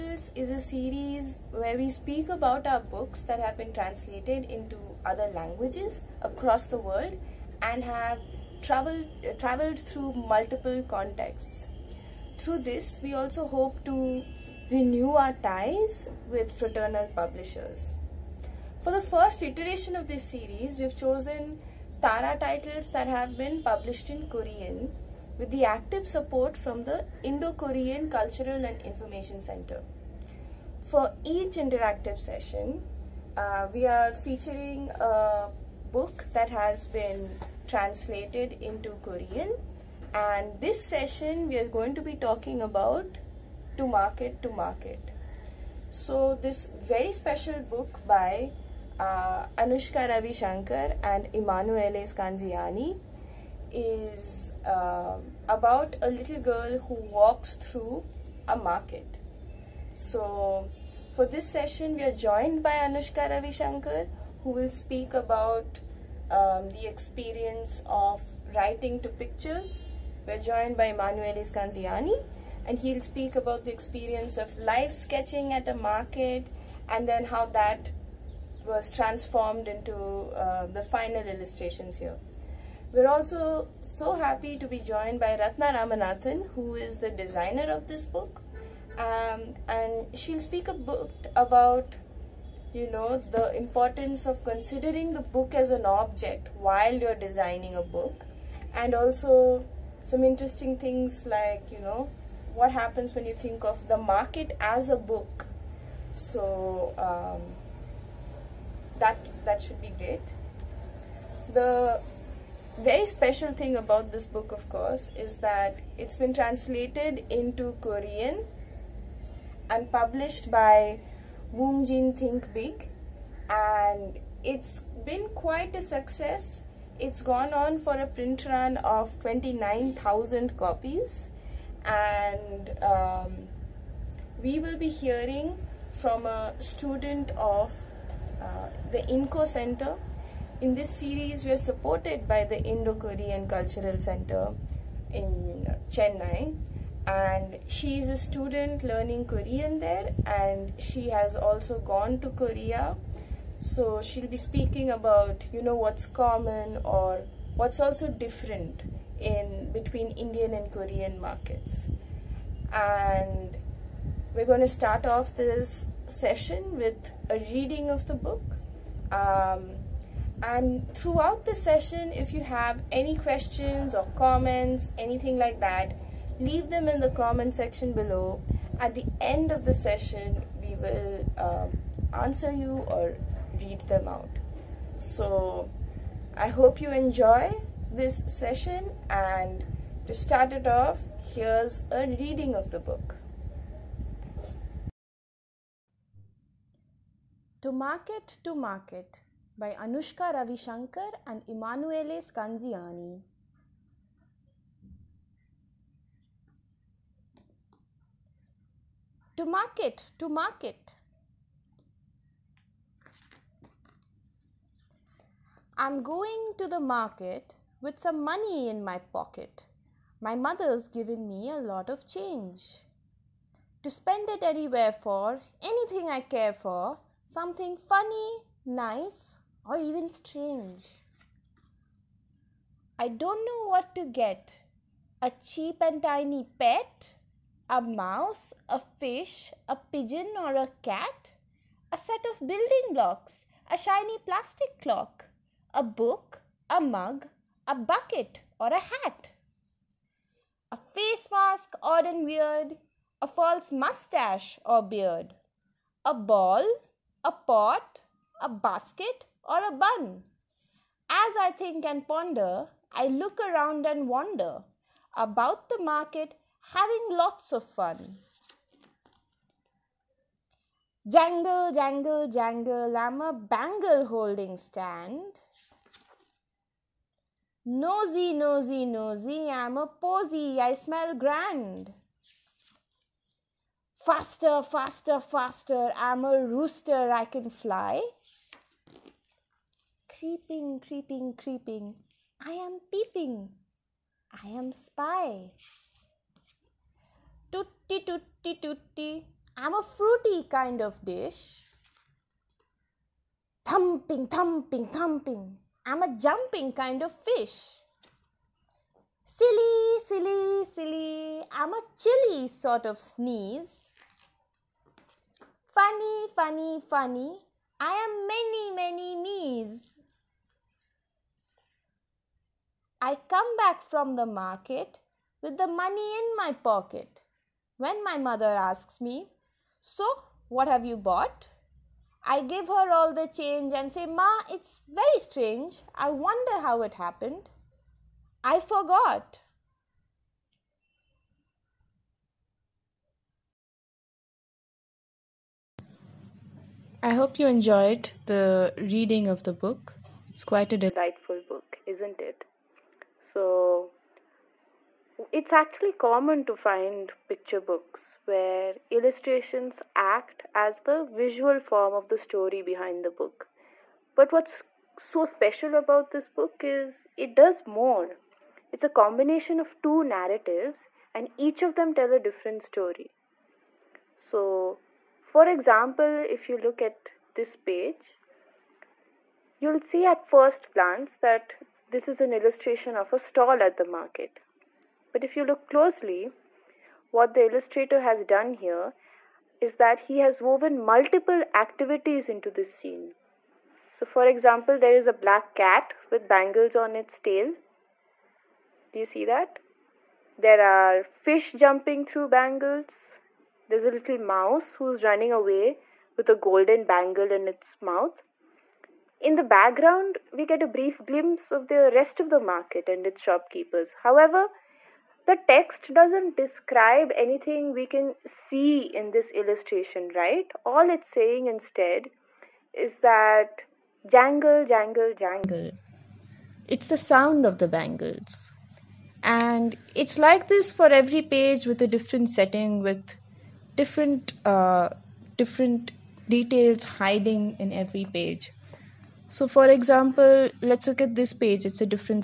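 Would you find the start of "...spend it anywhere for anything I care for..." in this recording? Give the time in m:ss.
3:43.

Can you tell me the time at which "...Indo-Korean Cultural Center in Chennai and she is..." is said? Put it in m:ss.
2:22.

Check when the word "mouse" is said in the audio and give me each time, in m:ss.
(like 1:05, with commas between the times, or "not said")
3:57, 6:44.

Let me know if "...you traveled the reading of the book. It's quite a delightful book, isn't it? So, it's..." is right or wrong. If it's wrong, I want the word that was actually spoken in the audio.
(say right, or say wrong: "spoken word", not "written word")
wrong: "enjoyed", not "traveled".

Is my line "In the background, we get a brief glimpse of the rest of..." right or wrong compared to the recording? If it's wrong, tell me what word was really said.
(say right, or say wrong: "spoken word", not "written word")
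right.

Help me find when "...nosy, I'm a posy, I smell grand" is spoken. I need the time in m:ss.
4:38.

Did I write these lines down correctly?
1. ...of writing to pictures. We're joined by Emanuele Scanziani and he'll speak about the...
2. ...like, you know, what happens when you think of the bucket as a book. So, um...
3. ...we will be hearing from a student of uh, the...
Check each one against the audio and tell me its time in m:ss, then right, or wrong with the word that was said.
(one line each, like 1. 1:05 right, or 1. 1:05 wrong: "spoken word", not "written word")
1. 1:07 right
2. 1:41 wrong: "market", not "bucket"
3. 2:14 right.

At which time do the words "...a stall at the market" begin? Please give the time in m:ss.
6:23.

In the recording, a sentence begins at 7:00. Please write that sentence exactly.
All it's saying instead is that jangle, jangle, jangle.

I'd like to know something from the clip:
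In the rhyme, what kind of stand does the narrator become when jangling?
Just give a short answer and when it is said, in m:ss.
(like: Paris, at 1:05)
bangle holding stand, at 4:33.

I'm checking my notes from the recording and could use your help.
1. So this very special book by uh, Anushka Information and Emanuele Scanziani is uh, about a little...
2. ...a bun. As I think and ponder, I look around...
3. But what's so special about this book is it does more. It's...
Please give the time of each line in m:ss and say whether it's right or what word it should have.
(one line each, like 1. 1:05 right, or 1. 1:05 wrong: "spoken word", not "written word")
1. 0:45 wrong: "Ravishankar", not "Information"
2. 4:19 right
3. 6:04 right.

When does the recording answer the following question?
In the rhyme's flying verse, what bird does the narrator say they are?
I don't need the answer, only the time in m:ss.
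4:46.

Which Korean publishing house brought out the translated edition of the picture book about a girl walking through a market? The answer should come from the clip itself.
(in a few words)
Woongjin Thinkbig.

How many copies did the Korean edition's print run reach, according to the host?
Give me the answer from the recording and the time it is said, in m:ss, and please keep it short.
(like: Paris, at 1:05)
29,000, at 2:09.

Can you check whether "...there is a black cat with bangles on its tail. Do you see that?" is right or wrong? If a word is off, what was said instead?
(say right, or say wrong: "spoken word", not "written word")
right.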